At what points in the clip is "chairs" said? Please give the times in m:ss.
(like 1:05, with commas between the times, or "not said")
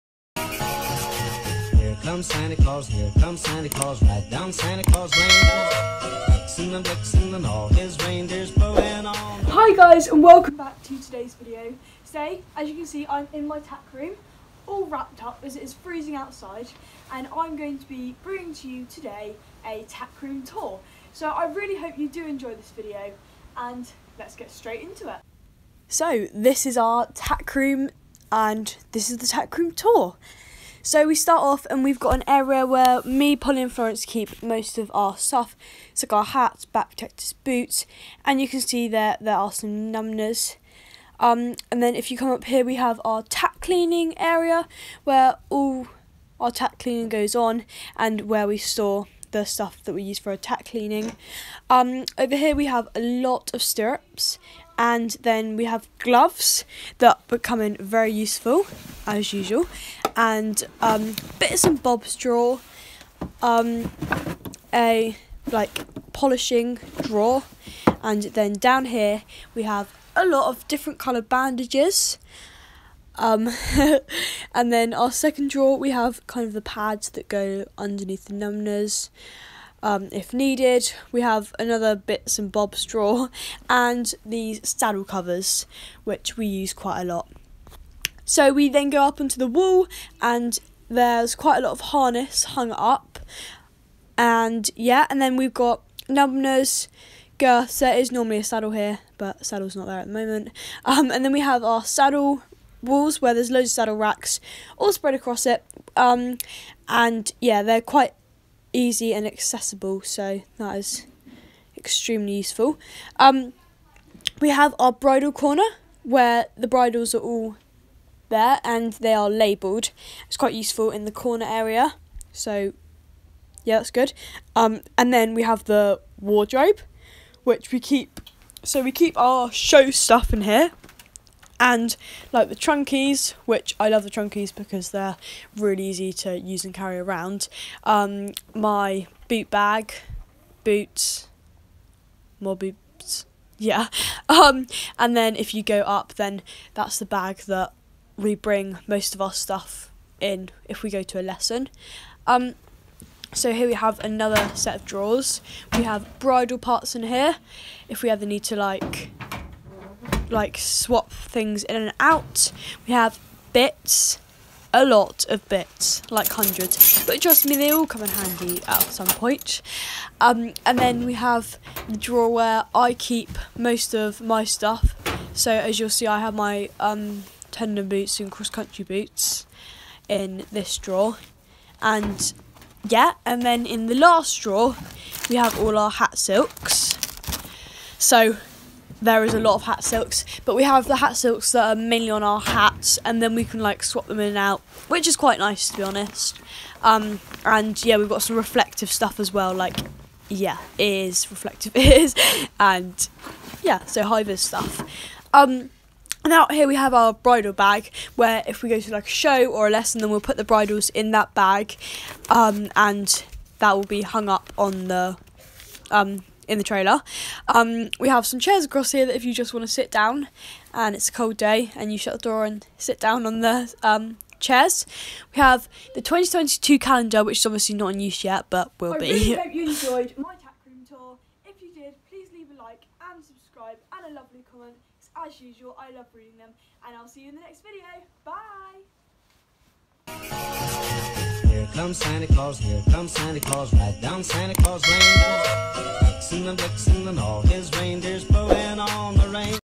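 3:38, 3:44.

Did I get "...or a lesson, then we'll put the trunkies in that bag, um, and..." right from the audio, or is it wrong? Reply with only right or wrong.
wrong.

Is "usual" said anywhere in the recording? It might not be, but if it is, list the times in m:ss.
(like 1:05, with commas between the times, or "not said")
0:59, 3:55.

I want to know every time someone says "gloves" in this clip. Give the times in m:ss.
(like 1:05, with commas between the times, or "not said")
0:55.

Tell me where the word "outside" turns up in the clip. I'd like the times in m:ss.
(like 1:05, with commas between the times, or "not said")
0:16.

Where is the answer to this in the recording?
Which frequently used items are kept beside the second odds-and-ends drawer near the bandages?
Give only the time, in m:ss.
1:24.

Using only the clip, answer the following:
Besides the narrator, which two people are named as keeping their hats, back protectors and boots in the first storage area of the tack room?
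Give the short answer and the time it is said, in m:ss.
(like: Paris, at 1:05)
Polly and Florence, at 0:33.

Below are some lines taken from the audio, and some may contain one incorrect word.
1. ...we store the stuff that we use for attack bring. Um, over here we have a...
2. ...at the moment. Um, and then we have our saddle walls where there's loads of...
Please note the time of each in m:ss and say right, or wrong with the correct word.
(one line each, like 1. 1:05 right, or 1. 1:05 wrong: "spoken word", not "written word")
1. 0:48 wrong: "cleaning", not "bring"
2. 1:39 right.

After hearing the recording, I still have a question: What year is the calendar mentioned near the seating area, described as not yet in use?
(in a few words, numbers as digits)
2022.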